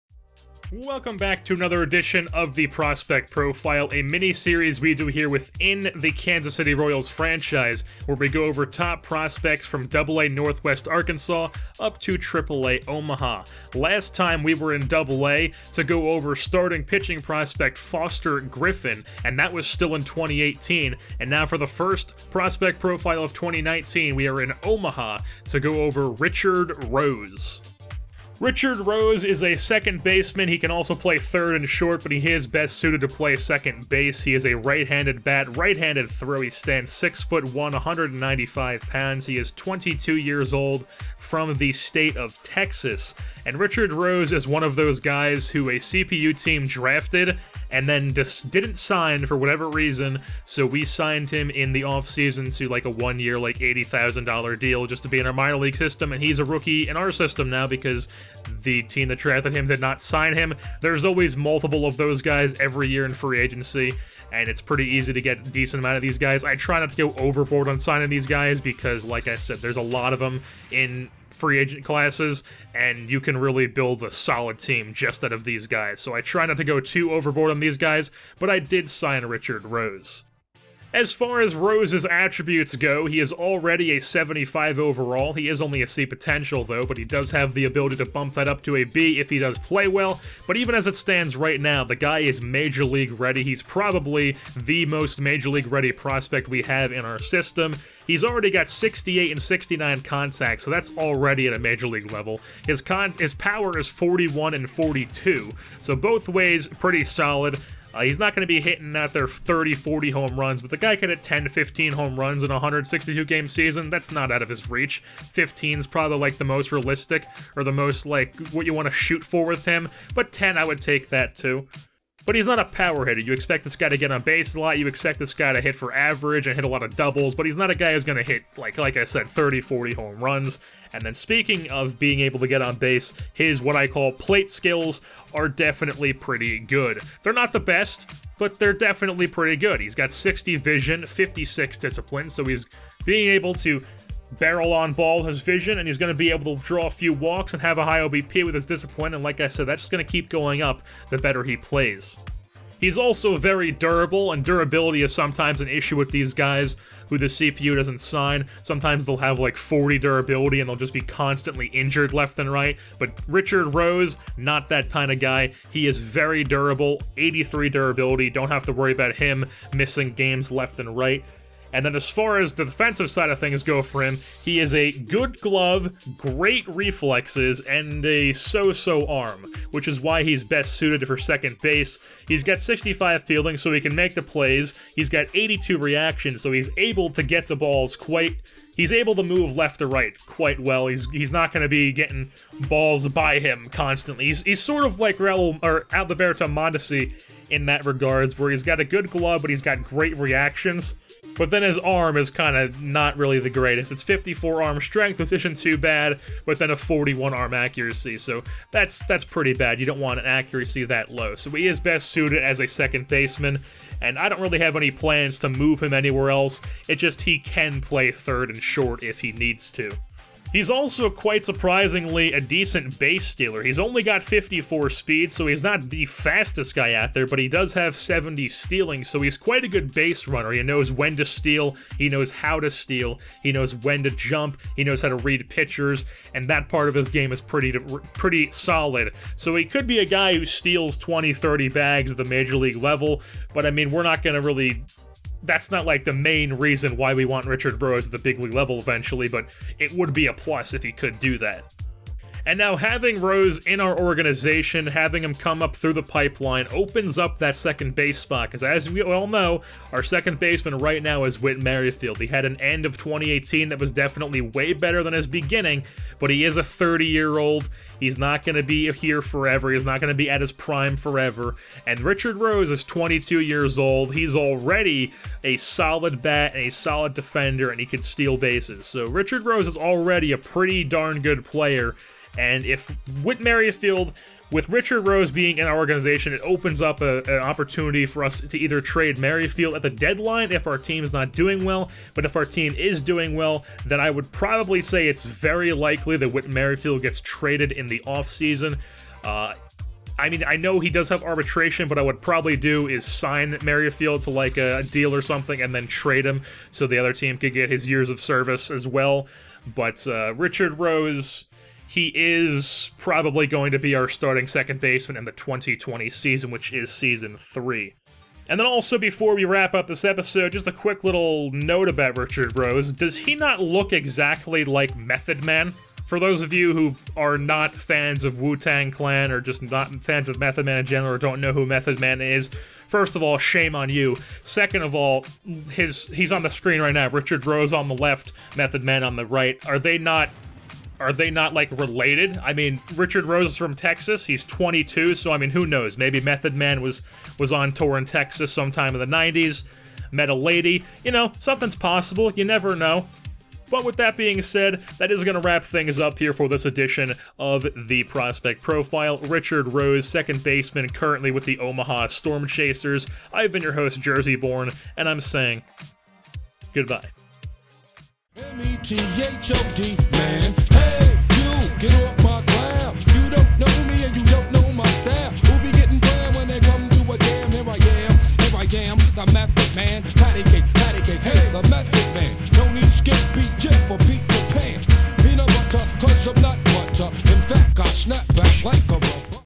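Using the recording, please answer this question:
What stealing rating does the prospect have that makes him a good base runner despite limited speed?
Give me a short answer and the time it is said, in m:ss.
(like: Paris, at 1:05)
70, at 3:47.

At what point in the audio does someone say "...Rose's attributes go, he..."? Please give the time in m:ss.
1:21.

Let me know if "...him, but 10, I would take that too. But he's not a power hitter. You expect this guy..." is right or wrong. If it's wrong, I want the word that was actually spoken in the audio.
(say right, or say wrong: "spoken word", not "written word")
right.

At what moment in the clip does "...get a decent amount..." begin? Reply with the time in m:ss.
1:05.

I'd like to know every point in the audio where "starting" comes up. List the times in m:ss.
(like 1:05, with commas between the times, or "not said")
0:16, 5:14.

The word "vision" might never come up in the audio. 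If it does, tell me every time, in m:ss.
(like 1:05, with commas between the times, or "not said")
2:20, 2:25.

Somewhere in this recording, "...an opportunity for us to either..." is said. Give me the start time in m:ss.
4:47.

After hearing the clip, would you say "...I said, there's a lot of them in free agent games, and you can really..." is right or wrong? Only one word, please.
wrong.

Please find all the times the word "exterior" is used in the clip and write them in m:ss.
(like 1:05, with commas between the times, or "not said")
not said.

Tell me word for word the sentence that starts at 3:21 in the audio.
But then his arm is kind of not really the greatest.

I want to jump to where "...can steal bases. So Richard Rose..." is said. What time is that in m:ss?
4:37.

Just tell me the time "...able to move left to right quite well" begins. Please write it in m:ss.
3:08.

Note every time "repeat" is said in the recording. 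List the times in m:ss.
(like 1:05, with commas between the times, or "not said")
not said.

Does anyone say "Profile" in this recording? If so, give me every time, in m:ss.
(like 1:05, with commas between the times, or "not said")
0:03, 0:22, 5:58.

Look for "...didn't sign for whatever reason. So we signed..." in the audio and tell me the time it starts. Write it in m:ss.
0:48.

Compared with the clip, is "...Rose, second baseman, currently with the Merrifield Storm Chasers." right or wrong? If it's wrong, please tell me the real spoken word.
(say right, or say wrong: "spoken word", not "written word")
wrong: "Omaha", not "Merrifield".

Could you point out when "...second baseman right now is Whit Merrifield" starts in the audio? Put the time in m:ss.
4:20.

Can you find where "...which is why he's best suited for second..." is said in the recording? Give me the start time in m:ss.
2:59.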